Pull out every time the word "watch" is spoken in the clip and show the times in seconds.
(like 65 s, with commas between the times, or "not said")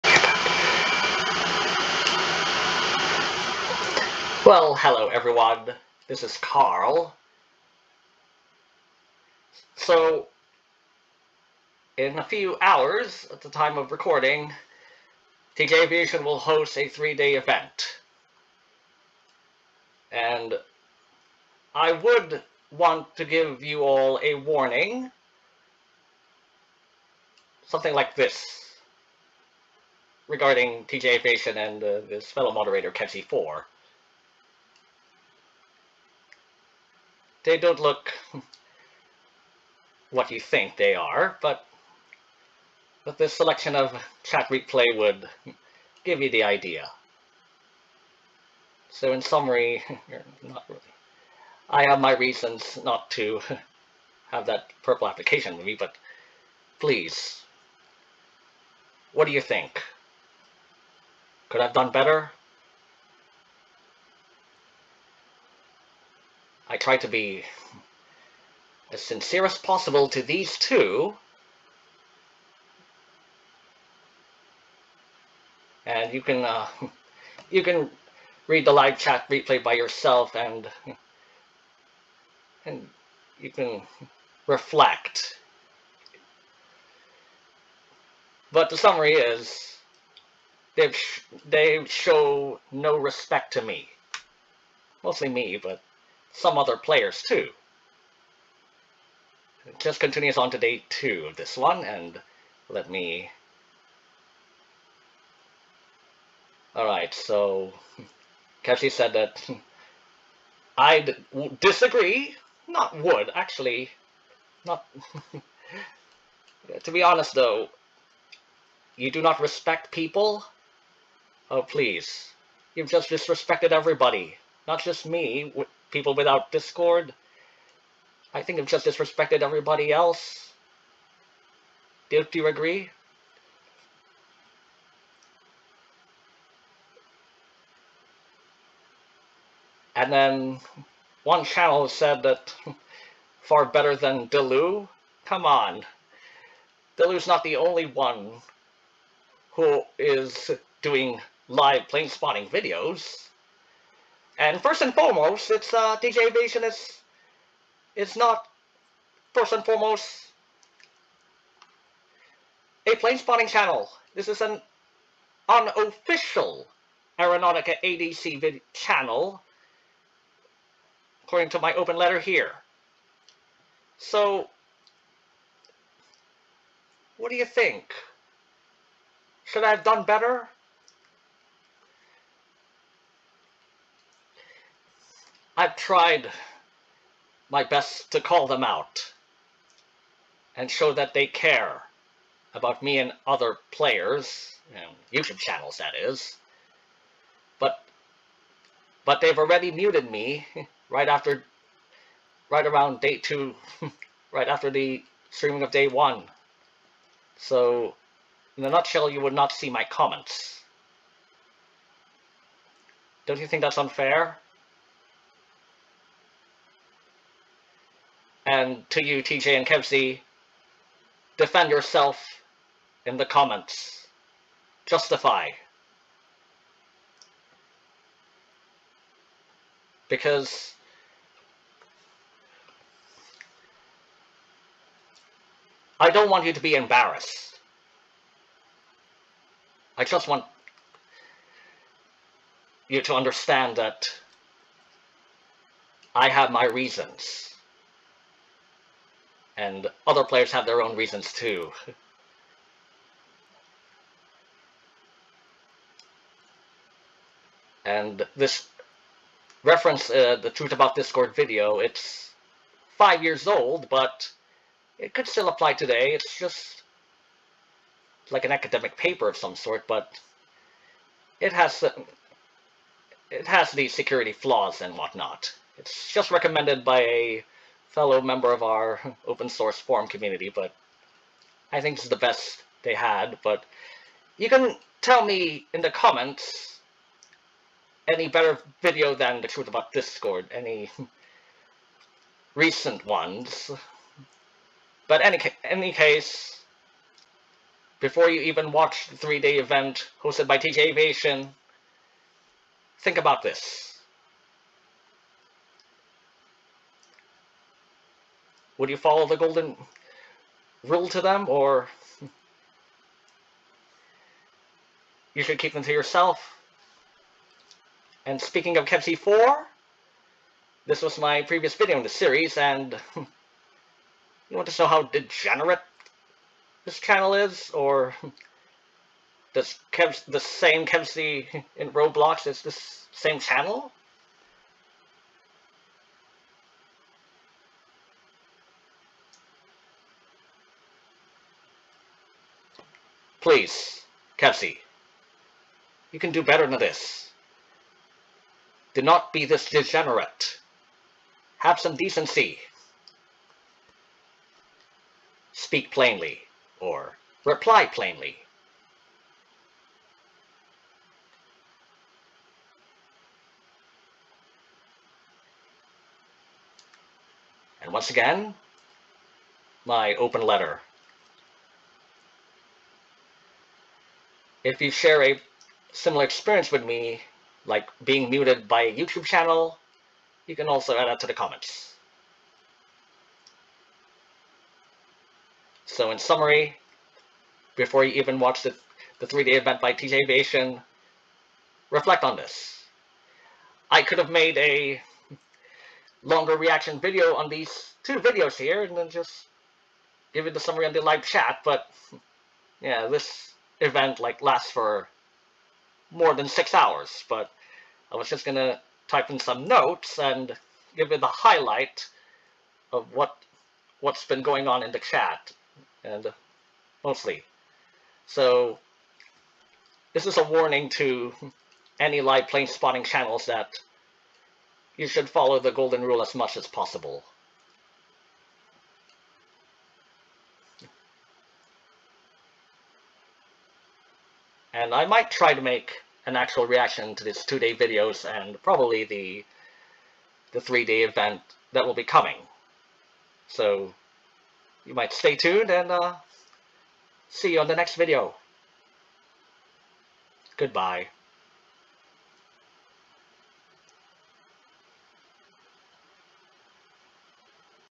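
298 s, 388 s.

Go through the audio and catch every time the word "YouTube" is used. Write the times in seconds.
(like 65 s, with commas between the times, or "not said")
195 s, 378 s.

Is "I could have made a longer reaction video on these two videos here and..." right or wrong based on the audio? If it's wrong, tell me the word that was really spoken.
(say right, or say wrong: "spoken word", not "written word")
right.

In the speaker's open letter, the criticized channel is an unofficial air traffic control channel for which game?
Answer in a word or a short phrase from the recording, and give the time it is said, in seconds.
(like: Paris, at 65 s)
Aeronautica, at 167 s.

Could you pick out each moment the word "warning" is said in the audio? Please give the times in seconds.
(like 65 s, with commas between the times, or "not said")
24 s, 420 s.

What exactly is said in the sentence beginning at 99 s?
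It just continues on to day two of this one, and let me...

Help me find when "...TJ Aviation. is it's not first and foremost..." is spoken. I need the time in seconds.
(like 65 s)
155 s.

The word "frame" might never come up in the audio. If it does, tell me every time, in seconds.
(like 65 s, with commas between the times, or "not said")
not said.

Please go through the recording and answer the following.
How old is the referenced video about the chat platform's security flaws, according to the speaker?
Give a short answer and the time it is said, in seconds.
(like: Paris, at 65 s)
5 years, at 262 s.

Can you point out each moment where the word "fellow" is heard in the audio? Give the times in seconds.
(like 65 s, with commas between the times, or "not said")
32 s, 277 s.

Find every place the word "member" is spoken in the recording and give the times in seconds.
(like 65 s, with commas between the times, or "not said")
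278 s.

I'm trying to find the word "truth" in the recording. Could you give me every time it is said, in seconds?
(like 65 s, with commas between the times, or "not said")
260 s, 289 s.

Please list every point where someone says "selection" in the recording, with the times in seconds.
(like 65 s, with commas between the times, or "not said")
43 s.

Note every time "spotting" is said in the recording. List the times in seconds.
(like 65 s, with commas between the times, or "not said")
152 s, 163 s, 422 s.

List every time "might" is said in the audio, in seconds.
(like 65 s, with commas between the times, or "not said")
435 s, 444 s.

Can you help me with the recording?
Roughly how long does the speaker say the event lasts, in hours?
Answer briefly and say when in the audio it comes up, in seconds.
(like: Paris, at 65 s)
More than 6 hours, at 406 s.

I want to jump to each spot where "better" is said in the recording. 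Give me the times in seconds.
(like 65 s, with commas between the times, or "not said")
61 s, 143 s, 180 s, 288 s, 346 s.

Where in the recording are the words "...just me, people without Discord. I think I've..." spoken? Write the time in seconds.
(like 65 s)
124 s.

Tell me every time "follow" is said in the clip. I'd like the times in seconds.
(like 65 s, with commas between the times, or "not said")
308 s, 425 s.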